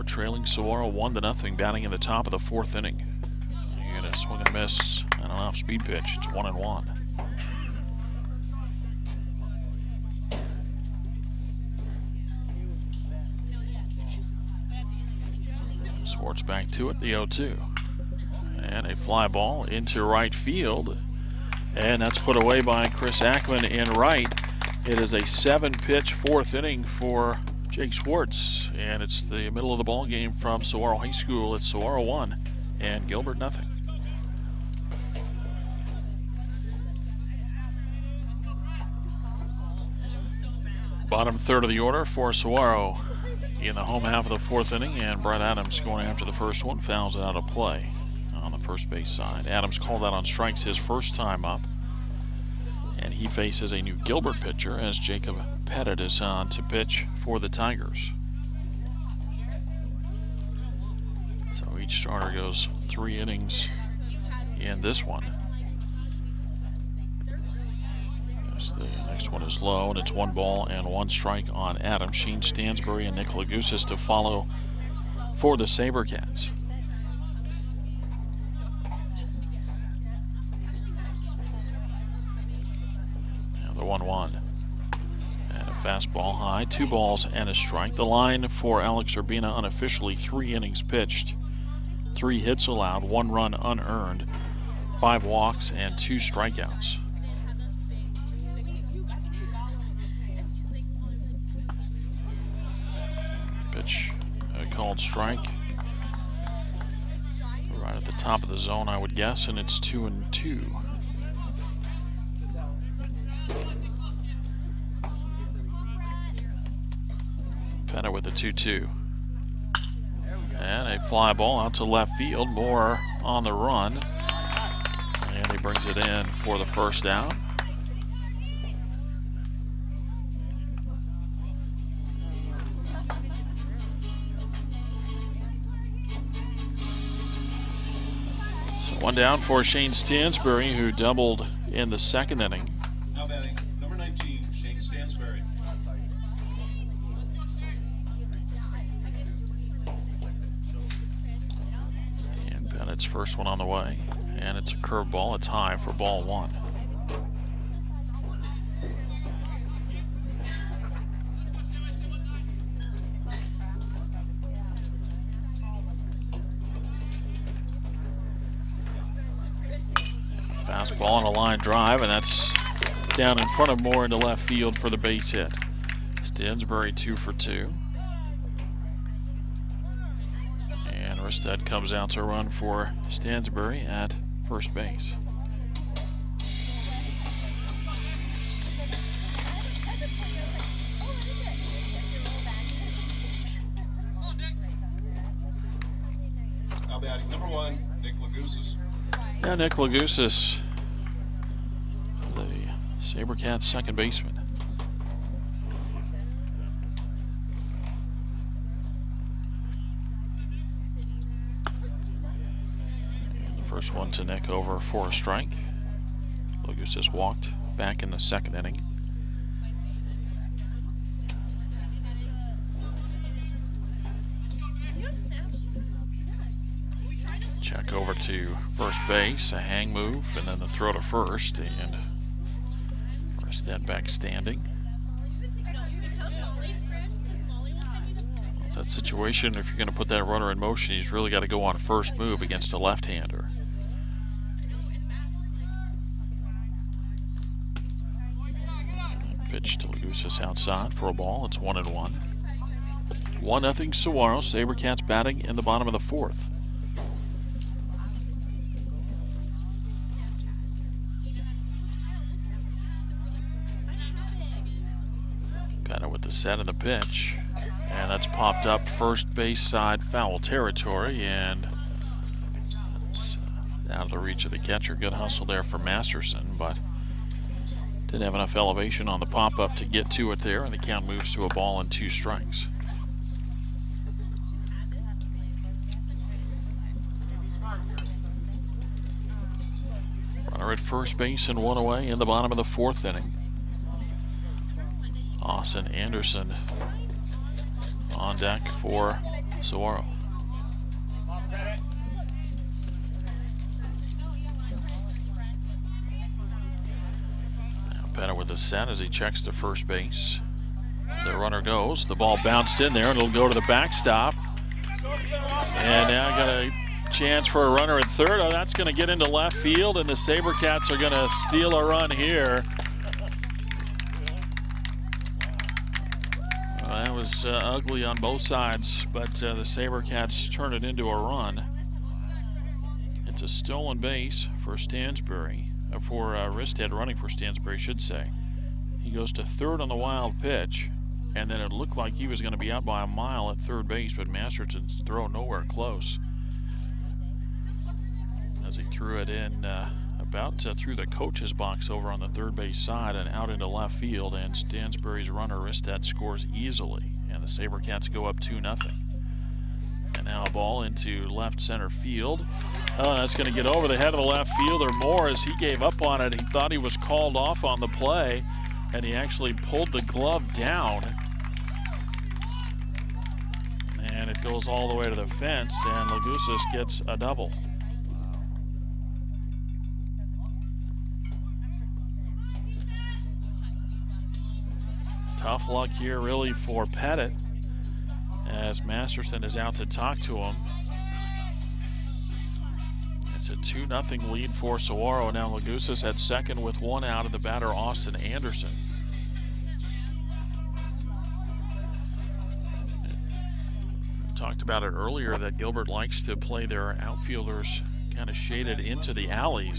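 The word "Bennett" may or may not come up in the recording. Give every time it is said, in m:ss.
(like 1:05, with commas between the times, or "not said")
2:32.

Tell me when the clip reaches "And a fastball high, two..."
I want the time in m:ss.
1:25.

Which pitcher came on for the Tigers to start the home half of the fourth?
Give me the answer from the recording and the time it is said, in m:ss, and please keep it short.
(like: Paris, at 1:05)
Jacob Pettit, at 0:54.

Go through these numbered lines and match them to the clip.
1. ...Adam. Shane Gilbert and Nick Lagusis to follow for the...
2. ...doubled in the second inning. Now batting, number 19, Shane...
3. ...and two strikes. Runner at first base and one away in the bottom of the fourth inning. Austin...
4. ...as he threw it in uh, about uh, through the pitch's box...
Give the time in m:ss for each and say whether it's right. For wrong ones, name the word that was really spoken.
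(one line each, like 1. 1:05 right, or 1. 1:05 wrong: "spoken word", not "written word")
1. 1:11 wrong: "Stansbury", not "Gilbert"
2. 2:20 right
3. 4:41 right
4. 5:48 wrong: "coach", not "pitch".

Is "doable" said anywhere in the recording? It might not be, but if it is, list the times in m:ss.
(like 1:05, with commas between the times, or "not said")
not said.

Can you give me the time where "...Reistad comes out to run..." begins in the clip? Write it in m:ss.
3:01.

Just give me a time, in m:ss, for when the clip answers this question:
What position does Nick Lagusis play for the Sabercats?
3:23.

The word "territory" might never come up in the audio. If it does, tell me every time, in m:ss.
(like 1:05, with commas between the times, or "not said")
4:30.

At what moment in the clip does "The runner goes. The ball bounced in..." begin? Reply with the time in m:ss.
5:11.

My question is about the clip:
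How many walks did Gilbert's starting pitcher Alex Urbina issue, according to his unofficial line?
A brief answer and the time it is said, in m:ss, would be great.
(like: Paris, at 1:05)
5, at 1:34.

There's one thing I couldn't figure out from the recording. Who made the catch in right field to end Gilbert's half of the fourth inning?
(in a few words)
Chris Ackman.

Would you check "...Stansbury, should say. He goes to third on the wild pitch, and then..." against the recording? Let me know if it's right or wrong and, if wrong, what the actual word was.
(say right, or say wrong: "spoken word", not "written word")
right.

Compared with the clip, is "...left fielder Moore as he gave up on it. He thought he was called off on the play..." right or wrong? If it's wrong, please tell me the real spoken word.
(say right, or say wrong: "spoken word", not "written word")
right.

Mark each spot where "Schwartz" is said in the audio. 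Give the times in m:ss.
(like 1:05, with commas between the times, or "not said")
0:16, 0:27.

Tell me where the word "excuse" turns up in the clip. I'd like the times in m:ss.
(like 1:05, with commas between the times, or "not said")
not said.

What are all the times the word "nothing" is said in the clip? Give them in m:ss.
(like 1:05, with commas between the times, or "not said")
0:01, 0:33, 4:13.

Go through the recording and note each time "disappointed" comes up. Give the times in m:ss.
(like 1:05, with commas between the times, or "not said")
not said.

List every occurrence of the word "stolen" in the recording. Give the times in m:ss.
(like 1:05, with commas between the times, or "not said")
5:33.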